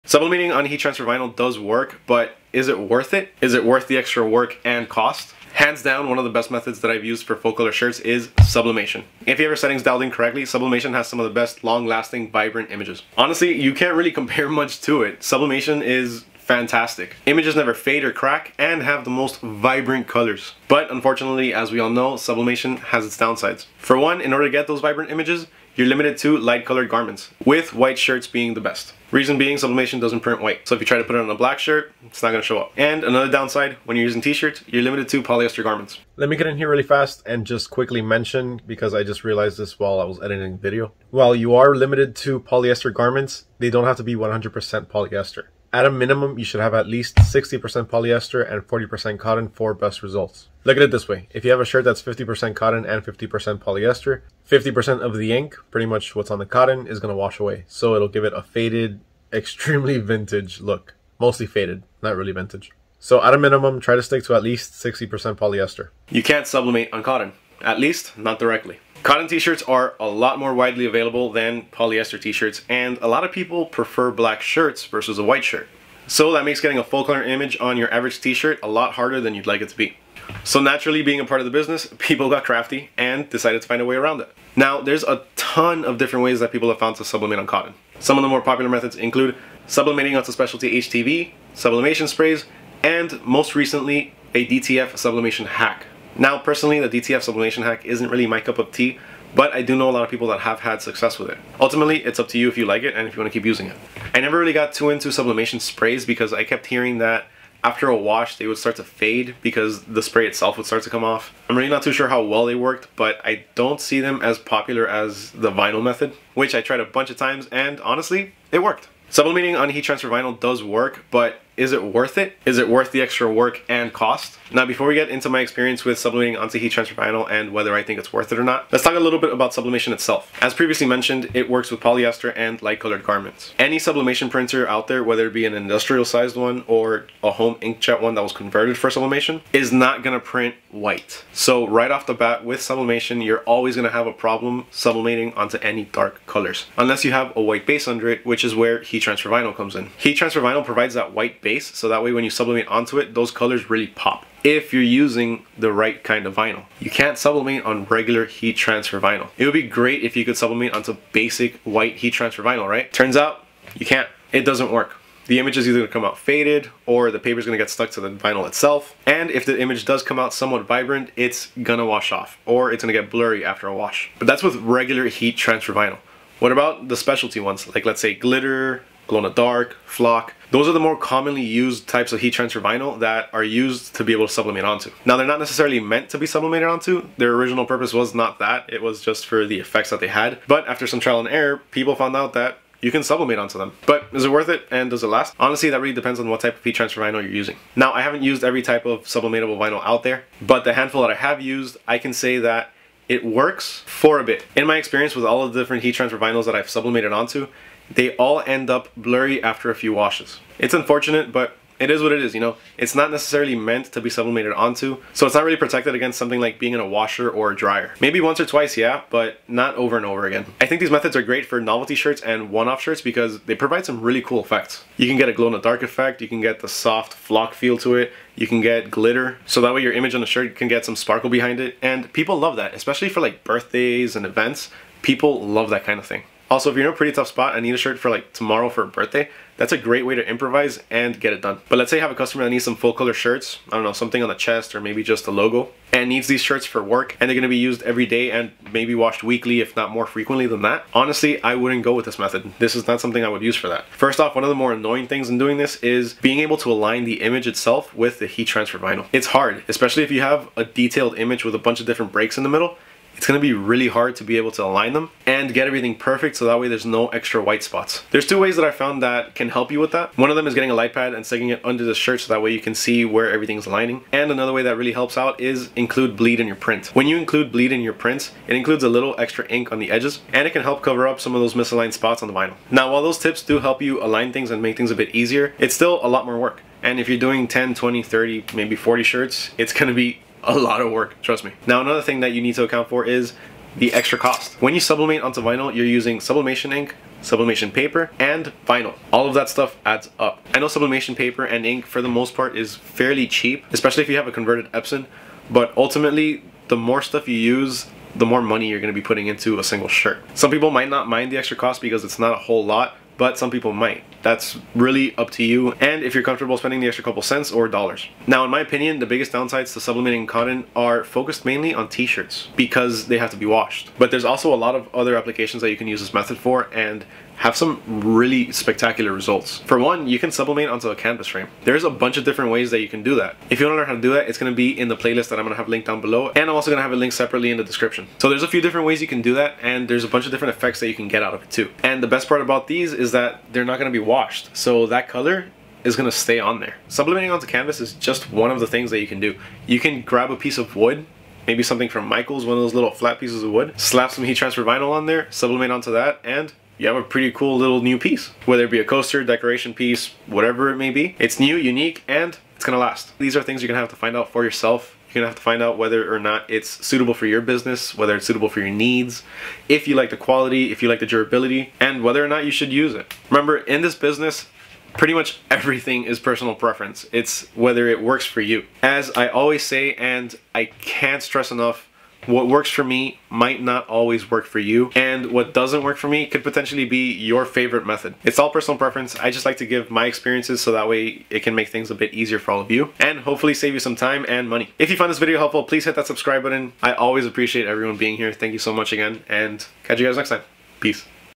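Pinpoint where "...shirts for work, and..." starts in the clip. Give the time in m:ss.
4:06.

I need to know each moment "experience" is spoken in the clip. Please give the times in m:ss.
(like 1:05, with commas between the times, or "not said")
2:05, 3:24, 6:30.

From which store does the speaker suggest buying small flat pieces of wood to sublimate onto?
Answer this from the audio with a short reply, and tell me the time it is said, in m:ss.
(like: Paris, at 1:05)
Michael's, at 5:52.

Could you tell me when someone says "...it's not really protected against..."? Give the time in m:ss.
3:35.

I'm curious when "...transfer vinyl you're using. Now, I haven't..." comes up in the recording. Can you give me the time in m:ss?
3:16.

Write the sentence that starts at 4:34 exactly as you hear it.
And another way that really helps out is include bleed in your print.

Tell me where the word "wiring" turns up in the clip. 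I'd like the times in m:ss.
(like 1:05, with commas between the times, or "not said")
not said.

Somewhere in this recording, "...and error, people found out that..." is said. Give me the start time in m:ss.
3:11.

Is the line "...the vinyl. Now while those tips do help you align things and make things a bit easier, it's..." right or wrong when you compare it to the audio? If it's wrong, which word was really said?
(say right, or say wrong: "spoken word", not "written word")
right.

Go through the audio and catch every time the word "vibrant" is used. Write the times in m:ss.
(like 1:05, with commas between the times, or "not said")
0:12, 0:19, 0:24, 2:50.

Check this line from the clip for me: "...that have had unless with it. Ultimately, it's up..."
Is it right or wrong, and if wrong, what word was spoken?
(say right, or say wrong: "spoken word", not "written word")
wrong: "success", not "unless".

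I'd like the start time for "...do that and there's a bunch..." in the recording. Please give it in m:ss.
5:39.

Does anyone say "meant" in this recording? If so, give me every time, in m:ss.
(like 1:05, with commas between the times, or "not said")
3:05, 3:33.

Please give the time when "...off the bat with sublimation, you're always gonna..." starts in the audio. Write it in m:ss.
2:21.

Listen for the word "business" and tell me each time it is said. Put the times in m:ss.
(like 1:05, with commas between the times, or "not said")
1:21, 6:07, 6:13.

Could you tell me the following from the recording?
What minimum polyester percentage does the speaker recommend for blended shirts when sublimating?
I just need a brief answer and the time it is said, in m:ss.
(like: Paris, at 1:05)
60%, at 0:47.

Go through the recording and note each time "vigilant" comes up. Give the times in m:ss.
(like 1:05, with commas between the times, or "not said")
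not said.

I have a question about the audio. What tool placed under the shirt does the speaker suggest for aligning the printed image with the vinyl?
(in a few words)
light pad.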